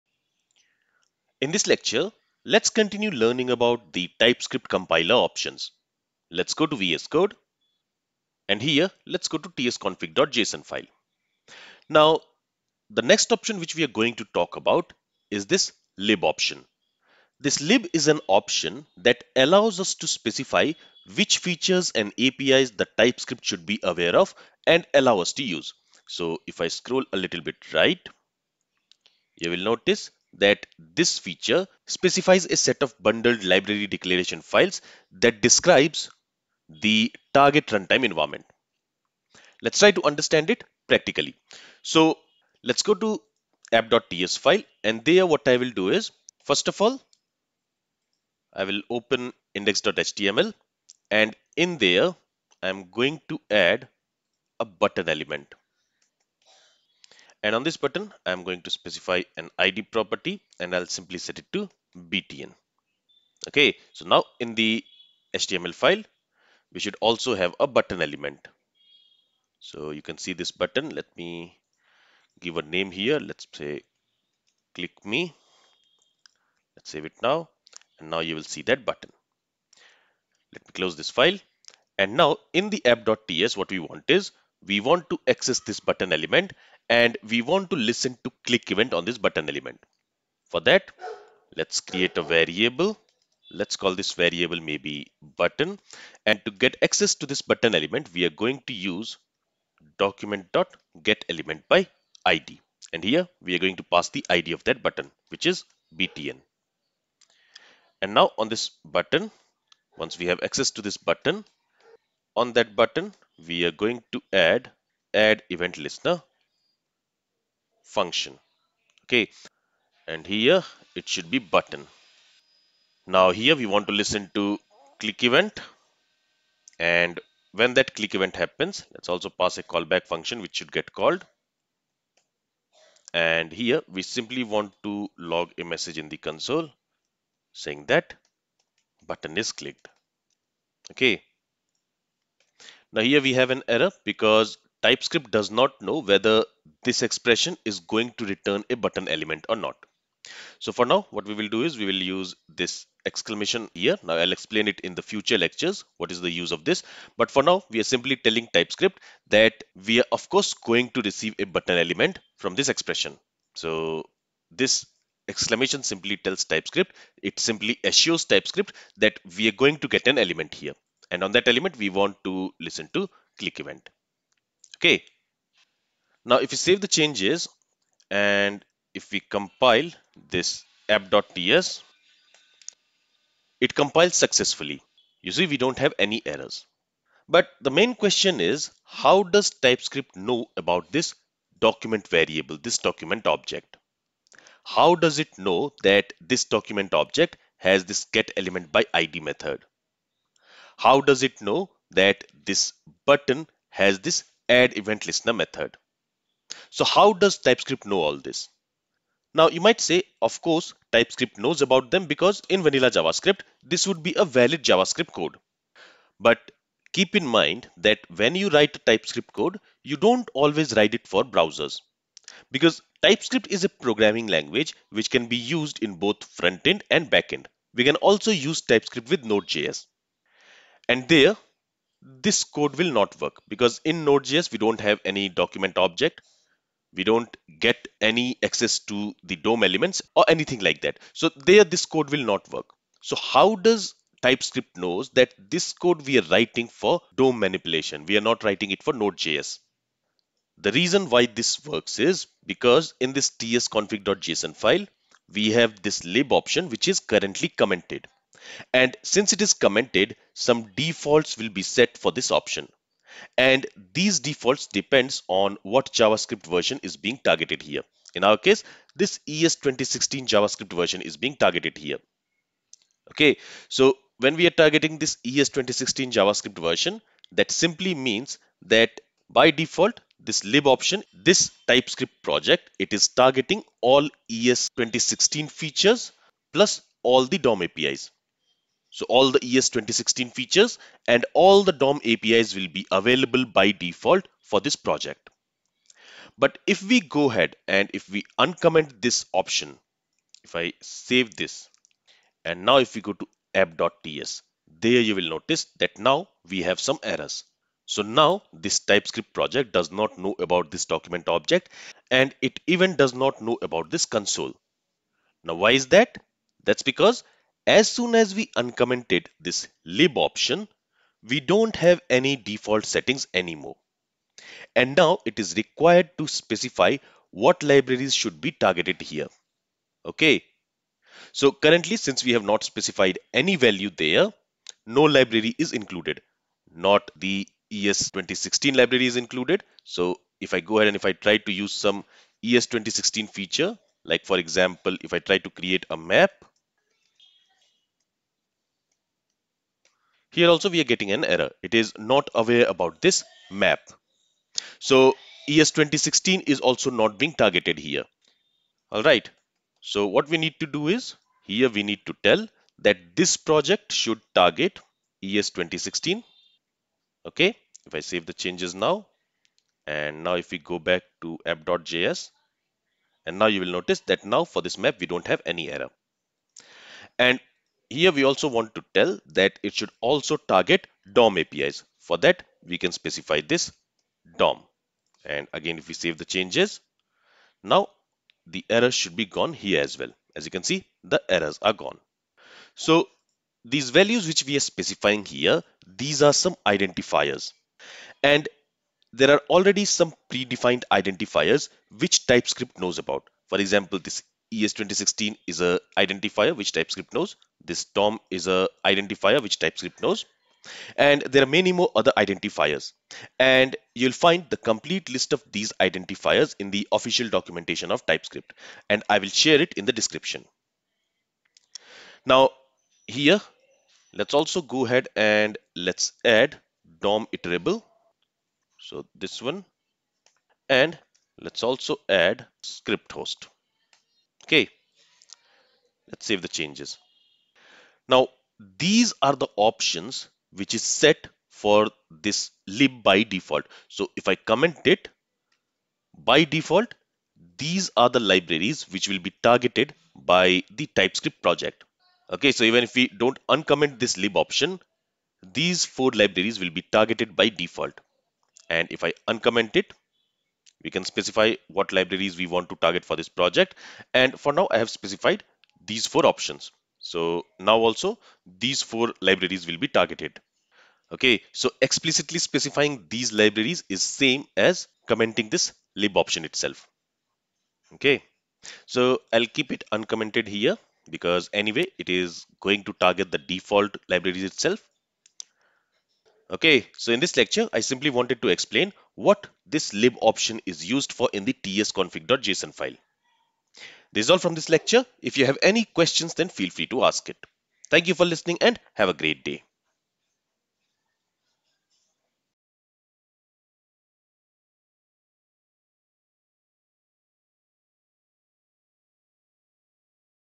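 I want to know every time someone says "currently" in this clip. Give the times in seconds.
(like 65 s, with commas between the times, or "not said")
256 s, 331 s.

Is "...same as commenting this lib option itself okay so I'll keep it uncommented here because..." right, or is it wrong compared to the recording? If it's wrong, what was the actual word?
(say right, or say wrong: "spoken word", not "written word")
right.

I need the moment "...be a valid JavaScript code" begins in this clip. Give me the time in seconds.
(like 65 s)
214 s.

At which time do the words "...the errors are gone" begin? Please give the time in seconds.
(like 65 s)
391 s.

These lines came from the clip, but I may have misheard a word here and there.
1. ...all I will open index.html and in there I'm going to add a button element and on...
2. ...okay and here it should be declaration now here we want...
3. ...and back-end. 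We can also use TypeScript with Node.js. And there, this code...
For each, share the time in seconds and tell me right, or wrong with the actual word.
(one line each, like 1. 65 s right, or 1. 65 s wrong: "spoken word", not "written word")
1. 46 s right
2. 119 s wrong: "button", not "declaration"
3. 226 s right.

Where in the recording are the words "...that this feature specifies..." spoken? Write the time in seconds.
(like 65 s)
30 s.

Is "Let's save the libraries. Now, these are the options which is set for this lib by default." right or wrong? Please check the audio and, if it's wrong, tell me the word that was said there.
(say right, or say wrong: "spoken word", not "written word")
wrong: "changes", not "libraries".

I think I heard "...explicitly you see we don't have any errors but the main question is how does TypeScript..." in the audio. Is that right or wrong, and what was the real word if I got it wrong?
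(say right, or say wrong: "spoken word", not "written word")
wrong: "successfully", not "explicitly".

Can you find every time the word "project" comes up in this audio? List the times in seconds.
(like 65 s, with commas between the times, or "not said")
282 s, 294 s, 309 s, 363 s, 451 s, 463 s.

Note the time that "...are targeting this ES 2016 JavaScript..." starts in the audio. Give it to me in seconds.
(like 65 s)
274 s.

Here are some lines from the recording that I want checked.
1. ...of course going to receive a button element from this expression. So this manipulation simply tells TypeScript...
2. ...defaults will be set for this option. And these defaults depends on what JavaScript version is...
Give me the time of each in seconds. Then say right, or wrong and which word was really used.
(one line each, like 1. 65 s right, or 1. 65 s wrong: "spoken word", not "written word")
1. 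160 s wrong: "exclamation", not "manipulation"
2. 260 s right.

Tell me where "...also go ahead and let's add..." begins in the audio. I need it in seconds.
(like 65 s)
424 s.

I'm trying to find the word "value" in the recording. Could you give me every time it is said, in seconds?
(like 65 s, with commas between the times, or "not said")
333 s, 393 s.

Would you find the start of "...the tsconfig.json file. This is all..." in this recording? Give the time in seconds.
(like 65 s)
491 s.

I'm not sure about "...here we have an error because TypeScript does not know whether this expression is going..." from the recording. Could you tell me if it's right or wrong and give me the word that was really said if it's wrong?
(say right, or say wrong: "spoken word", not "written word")
right.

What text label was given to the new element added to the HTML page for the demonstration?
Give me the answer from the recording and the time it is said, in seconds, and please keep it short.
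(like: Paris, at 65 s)
click me, at 74 s.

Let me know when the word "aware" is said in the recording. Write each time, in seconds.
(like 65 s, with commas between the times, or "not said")
23 s, 352 s.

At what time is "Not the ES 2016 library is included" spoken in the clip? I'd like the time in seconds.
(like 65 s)
336 s.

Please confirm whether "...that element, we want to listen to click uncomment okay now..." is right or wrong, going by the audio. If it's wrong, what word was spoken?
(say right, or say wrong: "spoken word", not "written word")
wrong: "event", not "uncomment".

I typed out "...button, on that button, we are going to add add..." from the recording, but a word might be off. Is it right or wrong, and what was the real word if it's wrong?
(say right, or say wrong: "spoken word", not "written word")
right.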